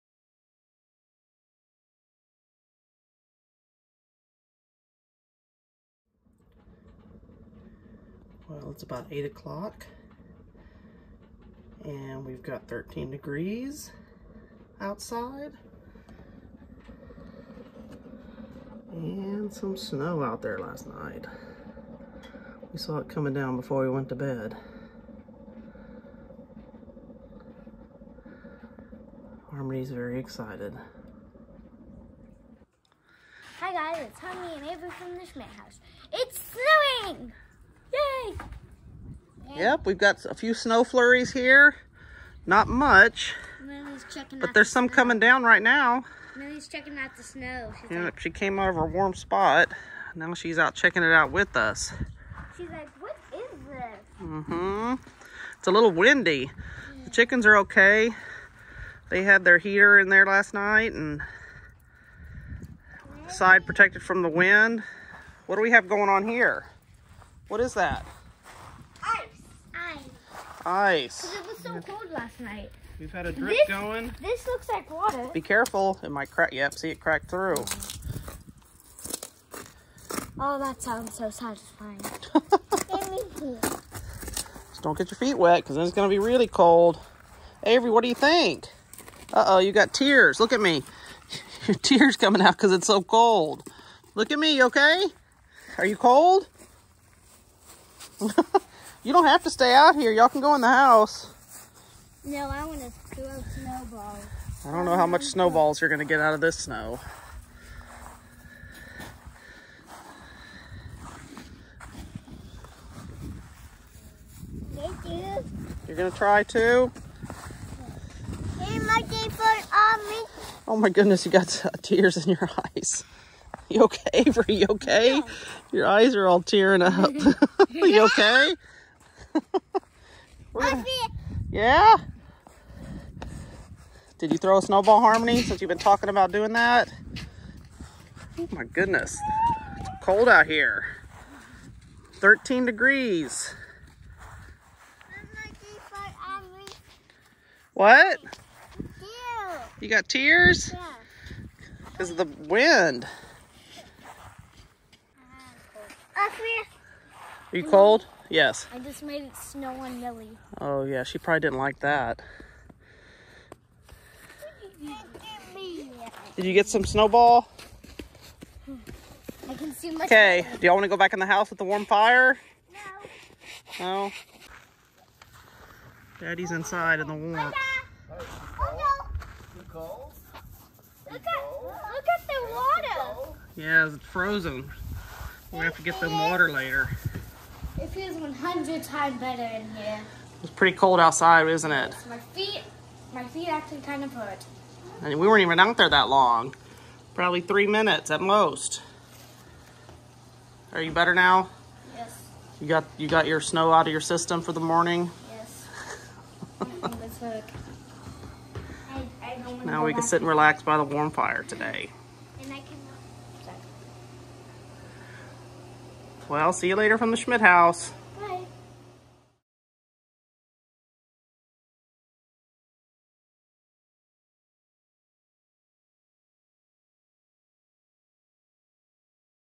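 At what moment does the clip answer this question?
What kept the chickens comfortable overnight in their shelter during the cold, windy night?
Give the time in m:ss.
0:59.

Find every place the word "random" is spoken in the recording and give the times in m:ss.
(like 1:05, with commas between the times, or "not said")
not said.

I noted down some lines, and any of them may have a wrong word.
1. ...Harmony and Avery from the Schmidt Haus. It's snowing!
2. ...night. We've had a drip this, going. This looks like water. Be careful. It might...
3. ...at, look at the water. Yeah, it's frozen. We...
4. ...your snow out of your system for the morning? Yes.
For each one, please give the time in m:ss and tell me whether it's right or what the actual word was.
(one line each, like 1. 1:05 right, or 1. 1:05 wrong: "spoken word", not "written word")
1. 0:34 right
2. 1:12 right
3. 3:01 right
4. 3:23 right.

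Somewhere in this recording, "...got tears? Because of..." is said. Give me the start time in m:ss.
2:29.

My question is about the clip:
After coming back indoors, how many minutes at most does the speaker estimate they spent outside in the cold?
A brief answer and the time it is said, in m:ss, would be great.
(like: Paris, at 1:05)
3, at 3:17.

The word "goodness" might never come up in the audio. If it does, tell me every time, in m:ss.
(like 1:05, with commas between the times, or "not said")
2:00, 2:18.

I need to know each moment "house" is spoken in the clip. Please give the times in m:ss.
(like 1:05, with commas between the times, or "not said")
1:40, 2:51.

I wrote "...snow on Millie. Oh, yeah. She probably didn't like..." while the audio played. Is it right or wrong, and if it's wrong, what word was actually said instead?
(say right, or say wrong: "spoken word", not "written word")
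right.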